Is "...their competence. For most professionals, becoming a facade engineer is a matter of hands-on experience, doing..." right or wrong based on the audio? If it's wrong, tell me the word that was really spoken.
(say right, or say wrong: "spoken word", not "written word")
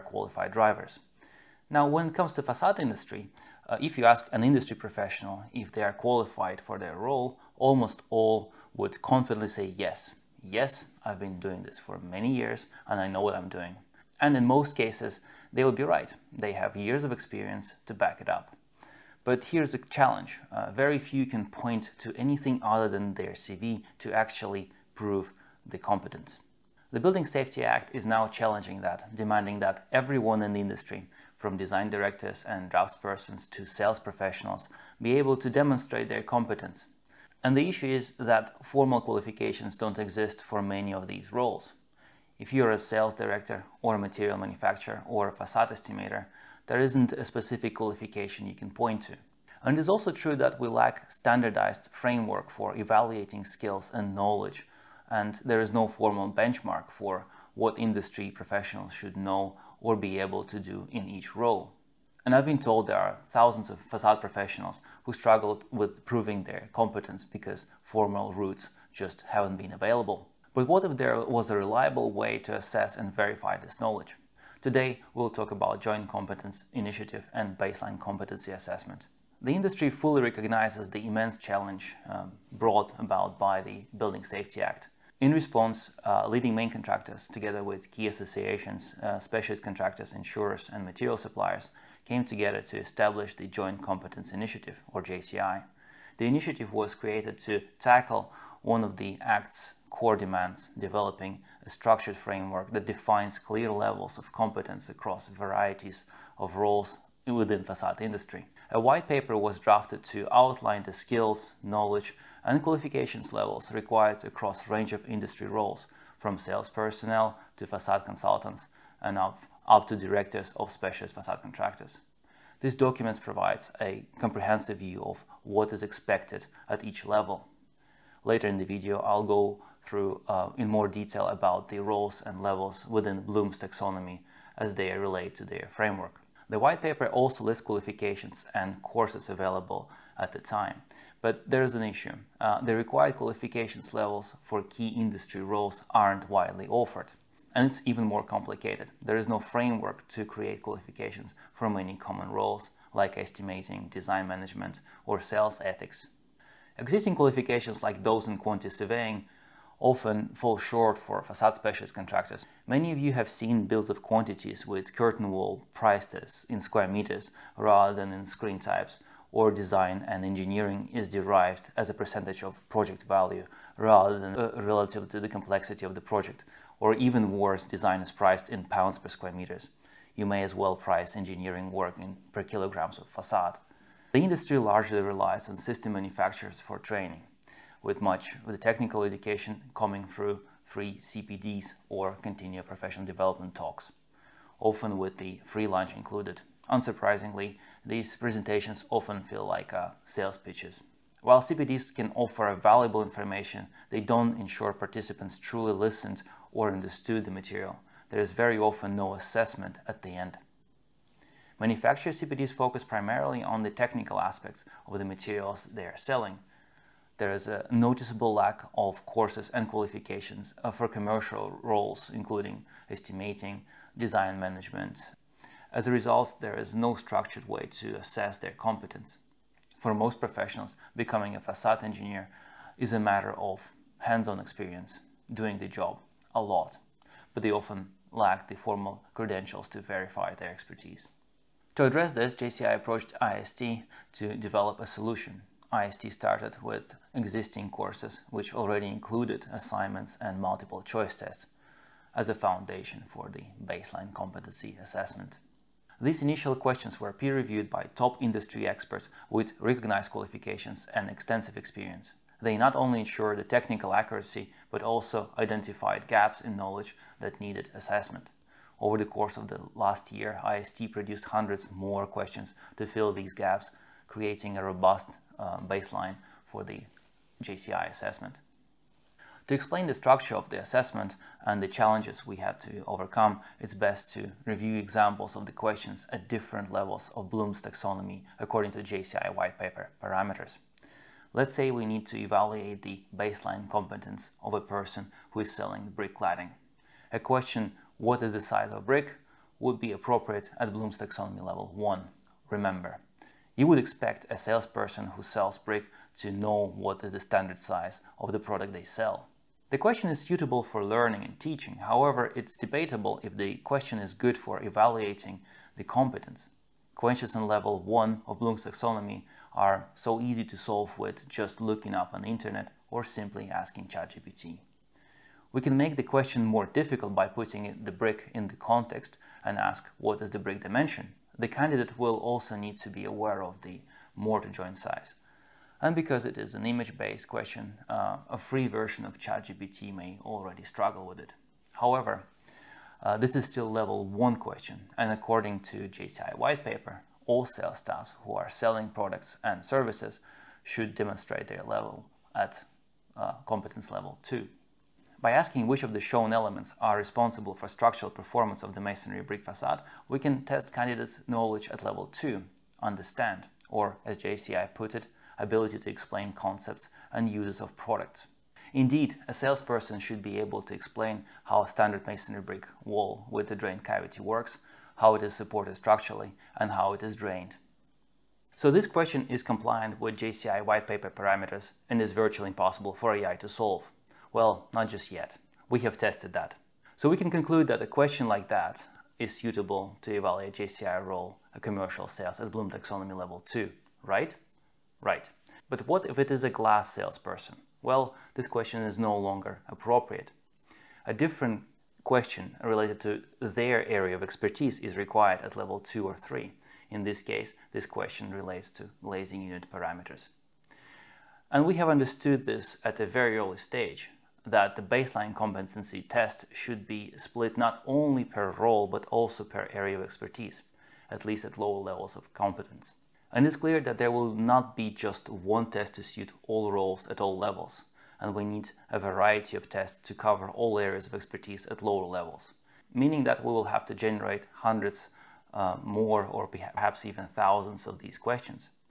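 right.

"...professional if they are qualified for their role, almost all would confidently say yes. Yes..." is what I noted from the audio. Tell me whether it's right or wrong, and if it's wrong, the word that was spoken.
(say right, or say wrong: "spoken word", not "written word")
right.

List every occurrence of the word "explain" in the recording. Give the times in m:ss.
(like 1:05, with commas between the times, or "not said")
4:39, 6:05, 6:10.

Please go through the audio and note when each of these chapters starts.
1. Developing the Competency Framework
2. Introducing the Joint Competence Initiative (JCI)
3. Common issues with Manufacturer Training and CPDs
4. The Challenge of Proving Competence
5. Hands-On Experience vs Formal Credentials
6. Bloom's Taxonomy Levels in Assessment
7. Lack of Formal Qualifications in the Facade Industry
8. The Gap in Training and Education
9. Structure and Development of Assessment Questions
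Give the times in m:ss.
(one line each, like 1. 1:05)
1. 1:49
2. 1:17
3. 2:54
4. 0:15
5. 3:26
6. 5:07
7. 0:46
8. 2:22
9. 4:33.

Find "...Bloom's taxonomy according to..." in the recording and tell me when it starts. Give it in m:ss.
4:47.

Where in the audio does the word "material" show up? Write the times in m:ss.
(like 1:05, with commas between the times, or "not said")
0:43, 1:30, 3:27, 3:35.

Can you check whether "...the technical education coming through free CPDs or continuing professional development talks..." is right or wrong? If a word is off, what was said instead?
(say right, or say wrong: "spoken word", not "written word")
right.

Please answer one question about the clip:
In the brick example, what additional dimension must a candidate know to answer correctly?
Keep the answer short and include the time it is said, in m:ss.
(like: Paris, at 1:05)
mortar joint size, at 5:34.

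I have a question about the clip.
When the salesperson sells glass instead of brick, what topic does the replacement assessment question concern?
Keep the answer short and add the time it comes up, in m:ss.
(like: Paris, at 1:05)
glazing unit parameters, at 6:49.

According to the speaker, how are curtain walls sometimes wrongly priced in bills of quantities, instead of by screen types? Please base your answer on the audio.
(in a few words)
in square meters.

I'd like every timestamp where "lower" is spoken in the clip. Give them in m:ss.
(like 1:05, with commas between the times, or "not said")
7:01, 7:11.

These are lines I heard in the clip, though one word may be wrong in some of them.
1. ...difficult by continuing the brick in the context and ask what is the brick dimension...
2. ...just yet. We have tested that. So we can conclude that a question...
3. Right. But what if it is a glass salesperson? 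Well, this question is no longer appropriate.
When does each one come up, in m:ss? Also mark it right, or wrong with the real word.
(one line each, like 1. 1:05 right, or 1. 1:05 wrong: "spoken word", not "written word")
1. 5:26 wrong: "putting", not "continuing"
2. 6:24 right
3. 6:34 right.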